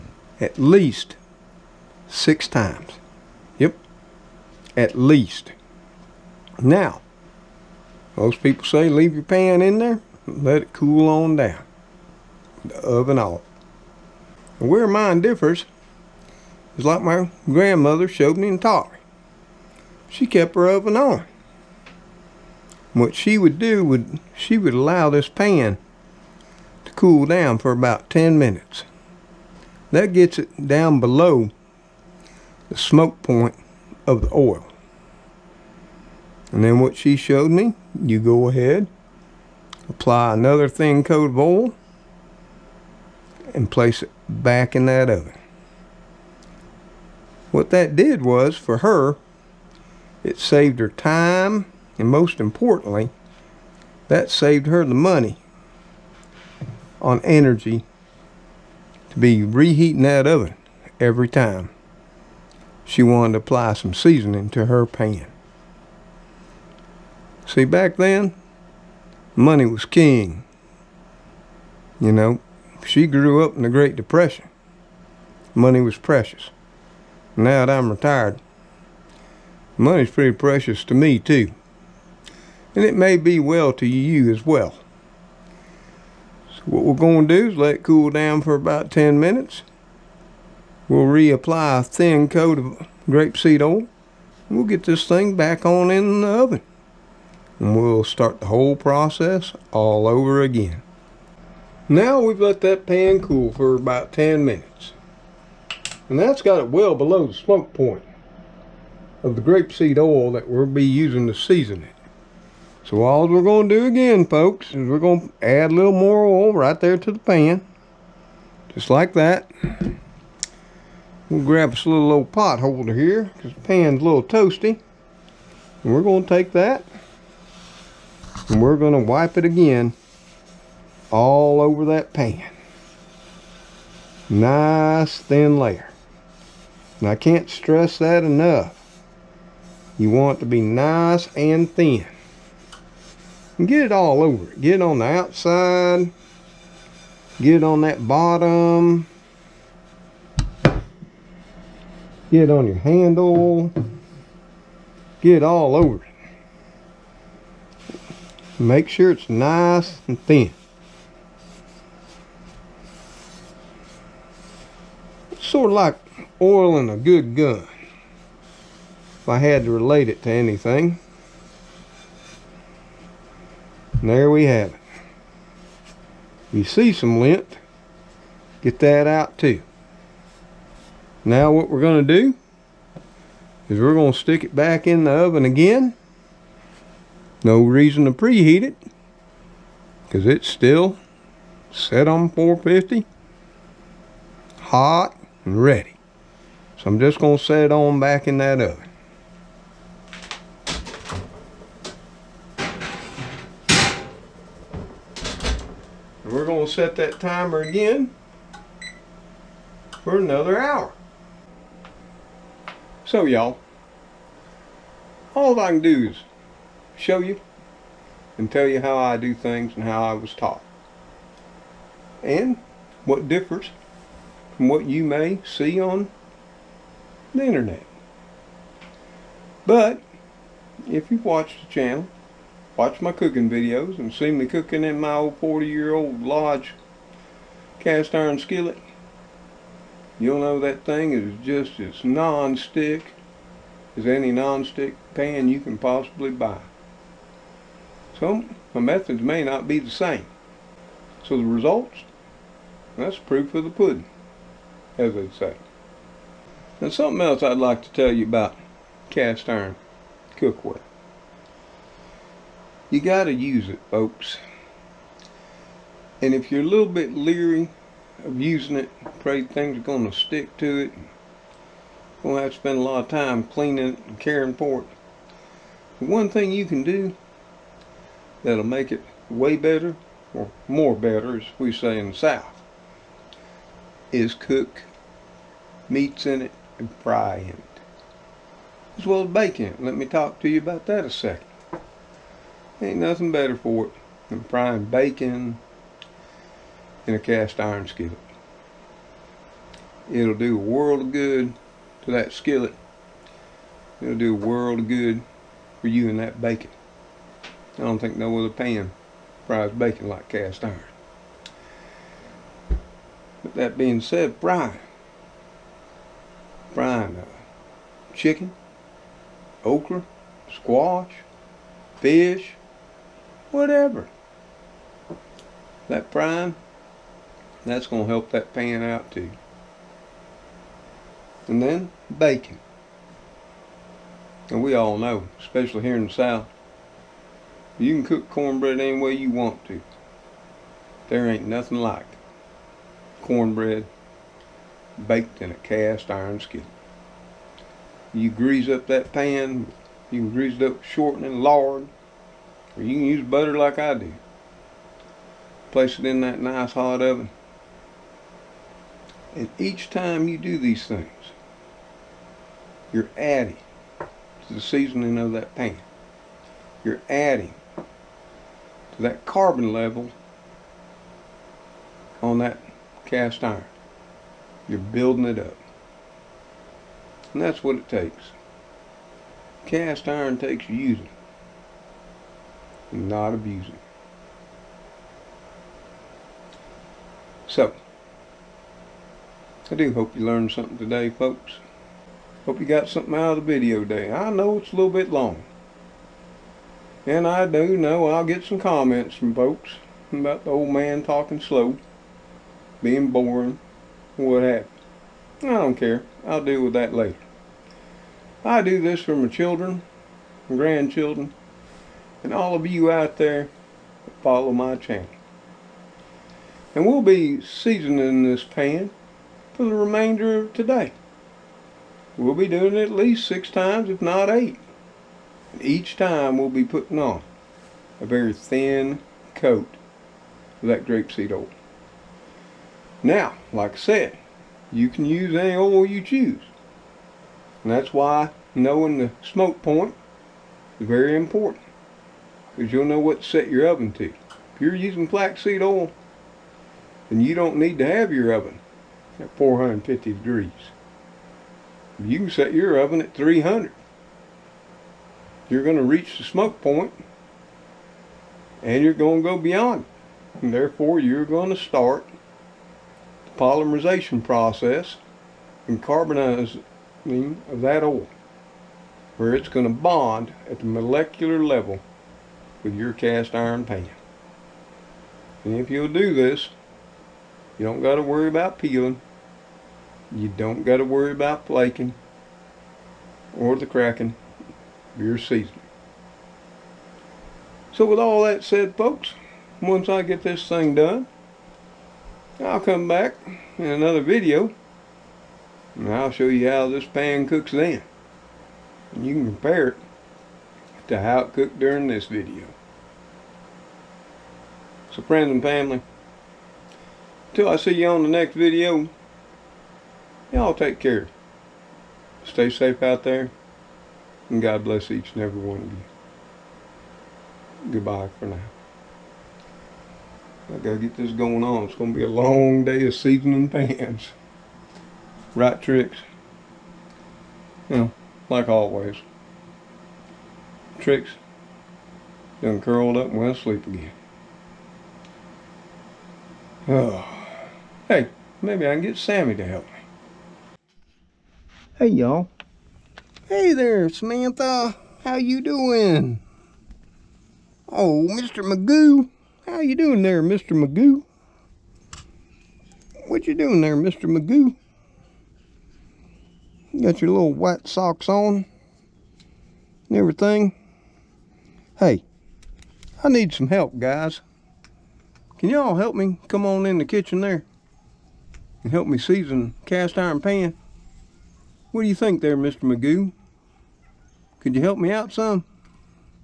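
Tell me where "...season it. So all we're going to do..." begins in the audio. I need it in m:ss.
1:51.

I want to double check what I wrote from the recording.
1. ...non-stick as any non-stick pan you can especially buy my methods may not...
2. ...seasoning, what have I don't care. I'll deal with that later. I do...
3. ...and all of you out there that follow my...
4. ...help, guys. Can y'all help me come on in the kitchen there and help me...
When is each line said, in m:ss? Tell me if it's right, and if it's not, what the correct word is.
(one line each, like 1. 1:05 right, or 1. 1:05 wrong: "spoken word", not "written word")
1. 4:02 wrong: "possibly", not "especially"
2. 6:43 wrong: "boring", not "seasoning"
3. 6:52 right
4. 9:23 right.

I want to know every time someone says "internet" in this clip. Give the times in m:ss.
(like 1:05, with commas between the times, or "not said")
3:47.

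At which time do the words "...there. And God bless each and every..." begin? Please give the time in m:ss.
8:33.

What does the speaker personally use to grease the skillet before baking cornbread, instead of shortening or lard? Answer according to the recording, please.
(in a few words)
Butter.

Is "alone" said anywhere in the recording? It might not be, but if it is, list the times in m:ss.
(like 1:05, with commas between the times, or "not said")
not said.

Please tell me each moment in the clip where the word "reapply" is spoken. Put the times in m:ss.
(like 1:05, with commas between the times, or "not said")
1:31.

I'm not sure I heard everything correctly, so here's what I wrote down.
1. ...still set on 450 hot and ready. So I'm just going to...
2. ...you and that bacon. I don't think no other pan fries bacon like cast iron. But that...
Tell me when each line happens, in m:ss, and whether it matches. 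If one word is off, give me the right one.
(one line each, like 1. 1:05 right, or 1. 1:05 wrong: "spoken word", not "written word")
1. 3:10 right
2. 5:05 right.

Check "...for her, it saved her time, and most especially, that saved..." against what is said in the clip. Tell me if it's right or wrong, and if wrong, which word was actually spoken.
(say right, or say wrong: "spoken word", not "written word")
wrong: "importantly", not "especially".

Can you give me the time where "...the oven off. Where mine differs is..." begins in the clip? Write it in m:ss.
0:12.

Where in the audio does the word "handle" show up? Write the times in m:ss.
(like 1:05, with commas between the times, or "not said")
2:32.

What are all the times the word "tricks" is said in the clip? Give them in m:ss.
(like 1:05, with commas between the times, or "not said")
8:45, 8:50.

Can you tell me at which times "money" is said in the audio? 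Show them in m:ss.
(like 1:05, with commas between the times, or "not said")
0:54, 1:09, 1:15, 1:19.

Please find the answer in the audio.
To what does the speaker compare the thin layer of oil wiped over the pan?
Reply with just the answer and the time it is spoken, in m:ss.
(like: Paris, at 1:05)
Oil in a good gun, at 2:46.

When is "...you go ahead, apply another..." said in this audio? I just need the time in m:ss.
0:38.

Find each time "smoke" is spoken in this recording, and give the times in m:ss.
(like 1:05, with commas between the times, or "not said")
0:32, 1:47, 7:19, 7:36.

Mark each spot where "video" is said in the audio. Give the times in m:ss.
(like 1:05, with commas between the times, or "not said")
3:53, 6:33, 8:14, 8:22, 8:28.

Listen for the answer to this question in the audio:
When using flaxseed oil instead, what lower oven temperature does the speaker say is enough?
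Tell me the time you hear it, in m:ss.
7:33.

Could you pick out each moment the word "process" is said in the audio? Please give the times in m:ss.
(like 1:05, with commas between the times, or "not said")
1:38, 7:44.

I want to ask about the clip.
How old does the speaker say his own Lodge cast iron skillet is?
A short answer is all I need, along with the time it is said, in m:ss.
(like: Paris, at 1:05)
40 years, at 3:55.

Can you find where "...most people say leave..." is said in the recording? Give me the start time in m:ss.
0:08.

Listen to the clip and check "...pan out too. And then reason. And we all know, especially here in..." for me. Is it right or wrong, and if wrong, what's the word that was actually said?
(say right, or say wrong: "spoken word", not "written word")
wrong: "bacon", not "reason".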